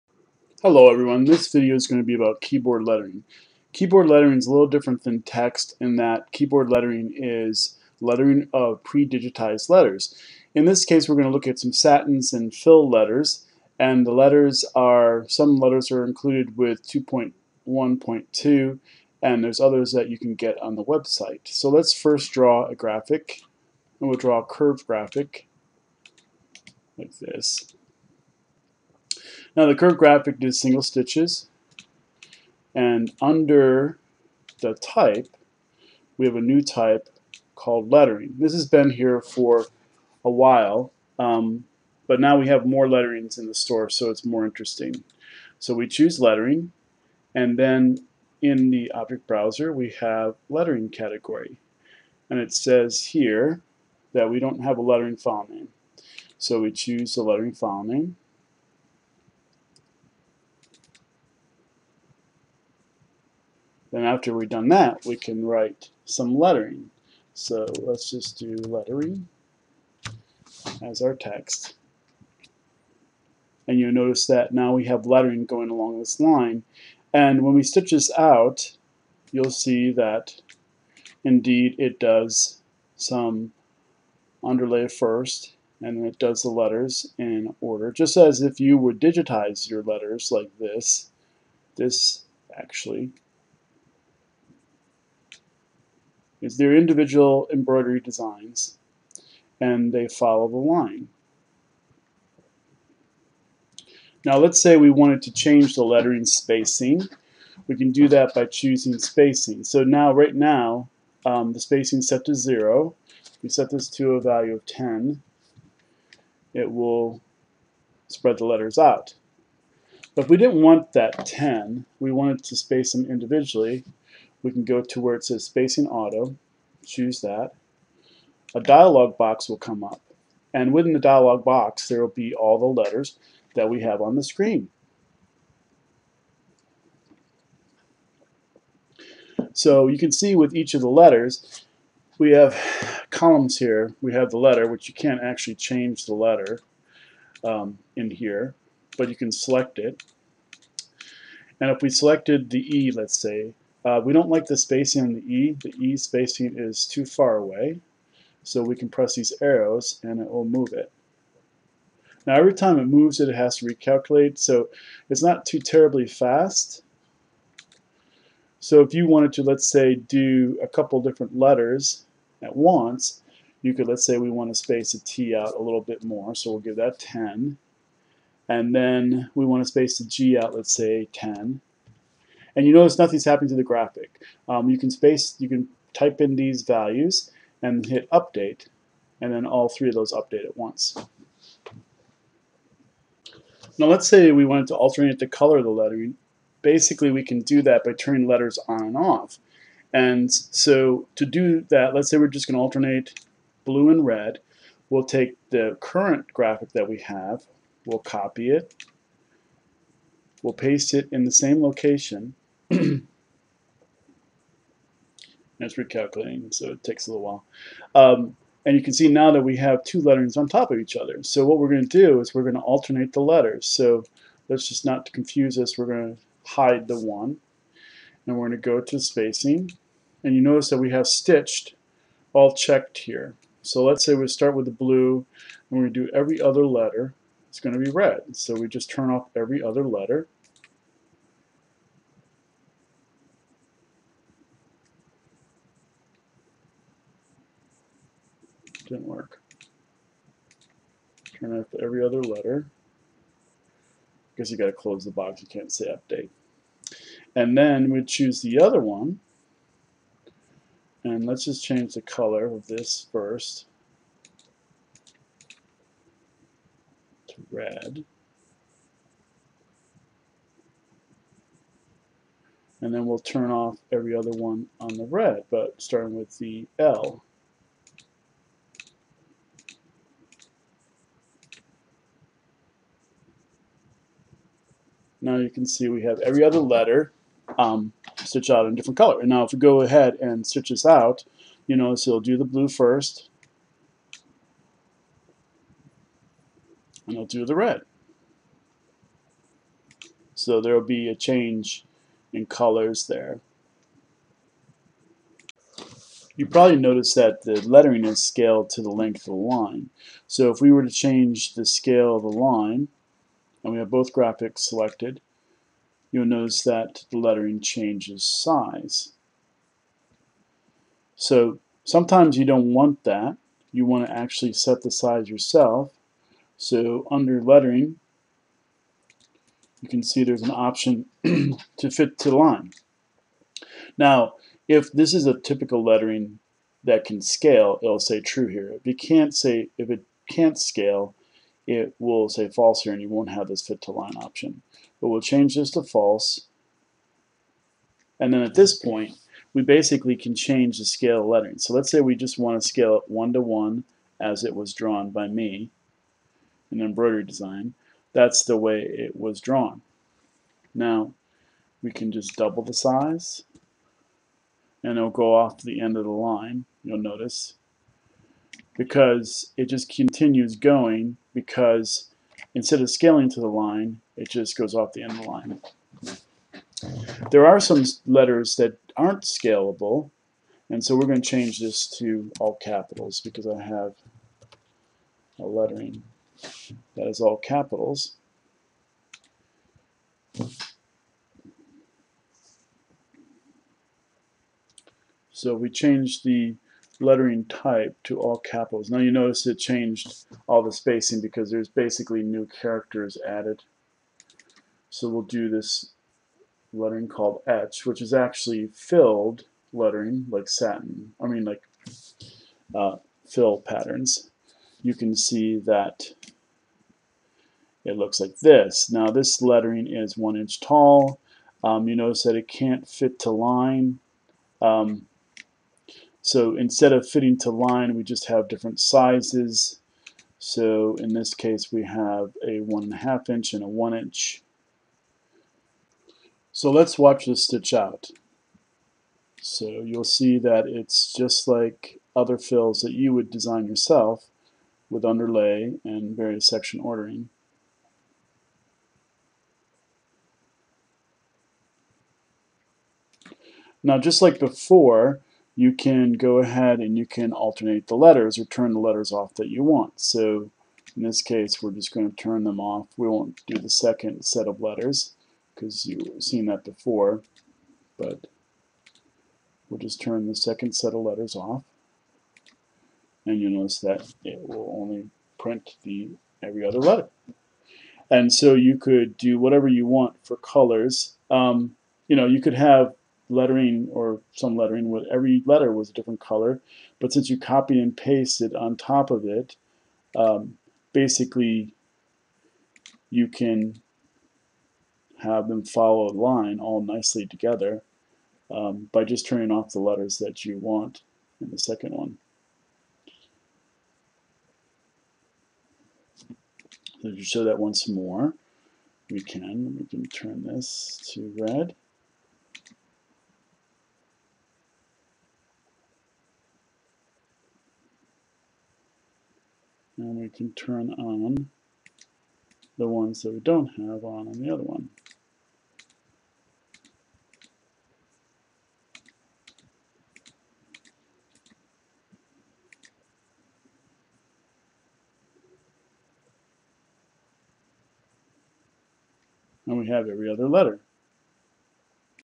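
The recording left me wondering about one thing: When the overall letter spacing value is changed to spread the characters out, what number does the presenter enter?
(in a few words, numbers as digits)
10.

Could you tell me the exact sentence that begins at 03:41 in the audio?
So what we're going to do is we're going to alternate the letters.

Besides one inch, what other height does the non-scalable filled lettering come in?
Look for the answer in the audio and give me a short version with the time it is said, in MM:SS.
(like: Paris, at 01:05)
1.5 inches, at 07:12.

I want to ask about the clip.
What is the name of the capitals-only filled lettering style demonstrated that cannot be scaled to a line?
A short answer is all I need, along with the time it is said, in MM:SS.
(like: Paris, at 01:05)
etch, at 06:47.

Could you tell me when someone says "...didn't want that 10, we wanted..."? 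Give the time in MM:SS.
02:00.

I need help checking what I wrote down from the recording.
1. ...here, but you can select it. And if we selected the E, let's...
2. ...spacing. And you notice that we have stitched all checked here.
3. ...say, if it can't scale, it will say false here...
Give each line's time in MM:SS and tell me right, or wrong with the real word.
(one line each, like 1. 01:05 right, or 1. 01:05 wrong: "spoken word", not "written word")
1. 02:28 right
2. 03:48 right
3. 05:39 right.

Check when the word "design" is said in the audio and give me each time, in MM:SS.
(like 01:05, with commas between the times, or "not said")
01:37, 05:57, 07:23.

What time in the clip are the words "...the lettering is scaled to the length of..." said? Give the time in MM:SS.
05:07.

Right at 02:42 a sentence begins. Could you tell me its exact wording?
Now every time it moves it, it has to recalculate.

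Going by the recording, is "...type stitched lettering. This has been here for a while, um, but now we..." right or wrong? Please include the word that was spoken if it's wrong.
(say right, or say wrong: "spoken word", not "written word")
wrong: "called", not "stitched".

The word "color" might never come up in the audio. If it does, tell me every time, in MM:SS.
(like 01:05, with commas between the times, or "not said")
03:15, 04:22, 04:48, 05:02, 08:00, 08:06.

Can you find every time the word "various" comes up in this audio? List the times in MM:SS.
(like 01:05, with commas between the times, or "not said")
07:26.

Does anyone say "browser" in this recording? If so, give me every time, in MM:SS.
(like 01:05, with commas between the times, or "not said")
00:49.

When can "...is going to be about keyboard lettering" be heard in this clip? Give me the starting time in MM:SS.
00:01.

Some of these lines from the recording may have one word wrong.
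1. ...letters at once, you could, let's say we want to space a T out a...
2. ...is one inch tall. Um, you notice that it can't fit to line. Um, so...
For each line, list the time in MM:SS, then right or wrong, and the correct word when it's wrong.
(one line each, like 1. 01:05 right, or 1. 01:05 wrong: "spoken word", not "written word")
1. 02:51 right
2. 06:59 right.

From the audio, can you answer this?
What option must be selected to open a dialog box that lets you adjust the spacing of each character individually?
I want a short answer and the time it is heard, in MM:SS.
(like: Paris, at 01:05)
spacing auto, at 02:05.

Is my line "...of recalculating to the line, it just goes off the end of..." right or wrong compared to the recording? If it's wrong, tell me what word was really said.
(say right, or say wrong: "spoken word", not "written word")
wrong: "scaling", not "recalculating".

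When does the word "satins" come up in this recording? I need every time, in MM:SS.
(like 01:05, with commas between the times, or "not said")
00:11, 06:50.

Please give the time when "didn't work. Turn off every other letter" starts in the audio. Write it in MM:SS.
04:08.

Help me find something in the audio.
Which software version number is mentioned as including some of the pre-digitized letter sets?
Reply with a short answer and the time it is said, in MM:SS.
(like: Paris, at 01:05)
2.1.2, at 00:16.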